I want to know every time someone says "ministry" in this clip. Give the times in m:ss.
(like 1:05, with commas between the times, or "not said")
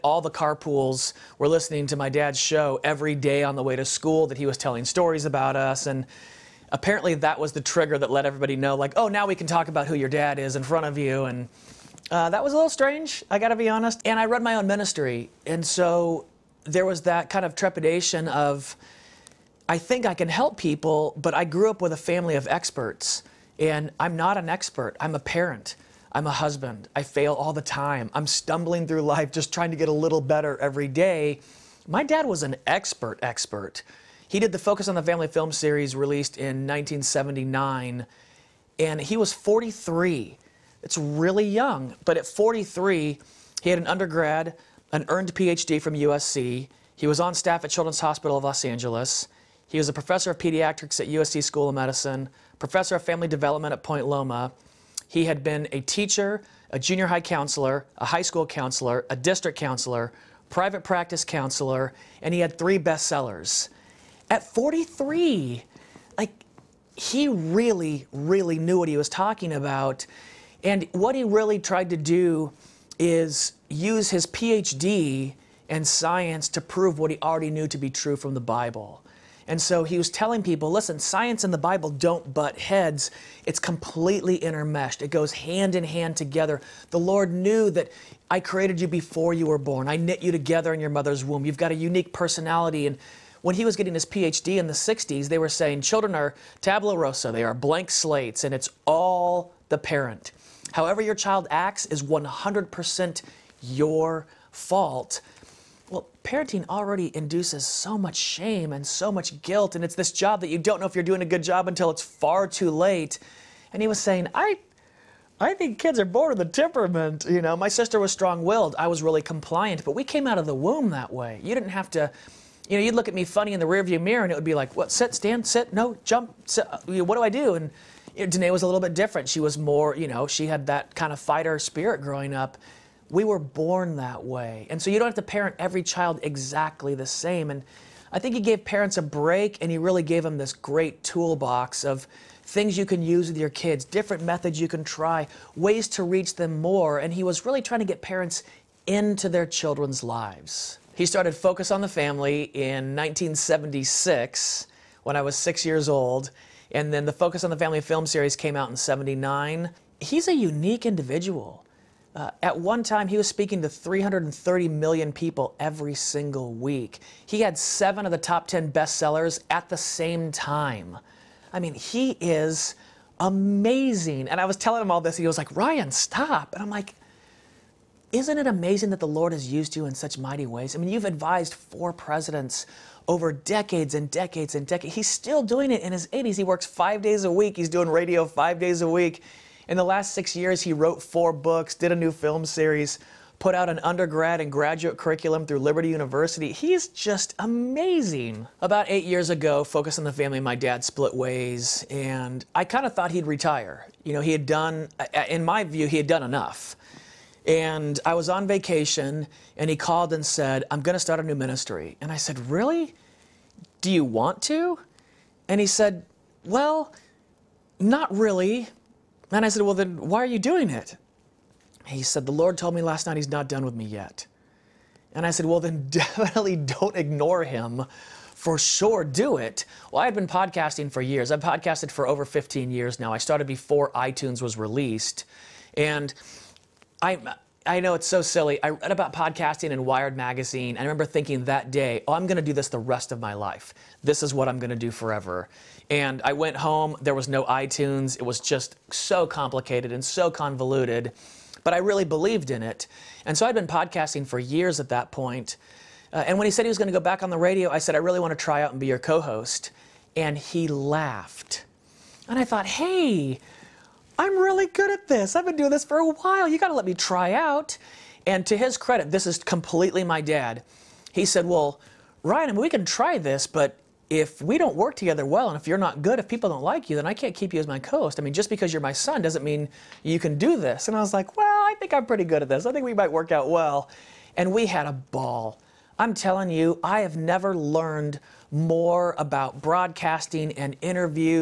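0:14, 3:31.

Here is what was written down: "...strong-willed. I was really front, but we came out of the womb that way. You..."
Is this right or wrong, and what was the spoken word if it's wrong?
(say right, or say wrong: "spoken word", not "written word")
wrong: "compliant", not "front".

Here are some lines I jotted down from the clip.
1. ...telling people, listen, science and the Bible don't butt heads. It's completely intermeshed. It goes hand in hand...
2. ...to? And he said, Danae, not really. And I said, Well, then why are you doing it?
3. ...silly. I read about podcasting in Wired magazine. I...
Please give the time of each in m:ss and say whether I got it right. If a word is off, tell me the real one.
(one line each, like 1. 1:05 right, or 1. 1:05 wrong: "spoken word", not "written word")
1. 1:20 right
2. 3:34 wrong: "Well", not "Danae"
3. 3:58 right.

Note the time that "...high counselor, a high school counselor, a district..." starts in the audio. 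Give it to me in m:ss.
0:57.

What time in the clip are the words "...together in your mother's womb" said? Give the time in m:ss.
1:30.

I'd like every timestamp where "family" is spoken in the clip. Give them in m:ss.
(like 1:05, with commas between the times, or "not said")
0:21, 0:35, 0:53, 2:31, 2:37, 3:20.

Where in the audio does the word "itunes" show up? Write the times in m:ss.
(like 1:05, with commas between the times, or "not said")
3:53, 4:07.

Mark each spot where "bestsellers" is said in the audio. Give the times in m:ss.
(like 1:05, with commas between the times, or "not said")
1:02, 2:48.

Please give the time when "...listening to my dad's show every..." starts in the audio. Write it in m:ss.
0:01.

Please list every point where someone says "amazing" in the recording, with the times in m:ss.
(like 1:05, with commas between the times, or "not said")
2:53, 2:58, 3:17.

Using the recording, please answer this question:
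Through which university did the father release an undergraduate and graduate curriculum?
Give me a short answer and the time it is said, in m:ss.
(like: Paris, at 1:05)
Liberty University, at 3:15.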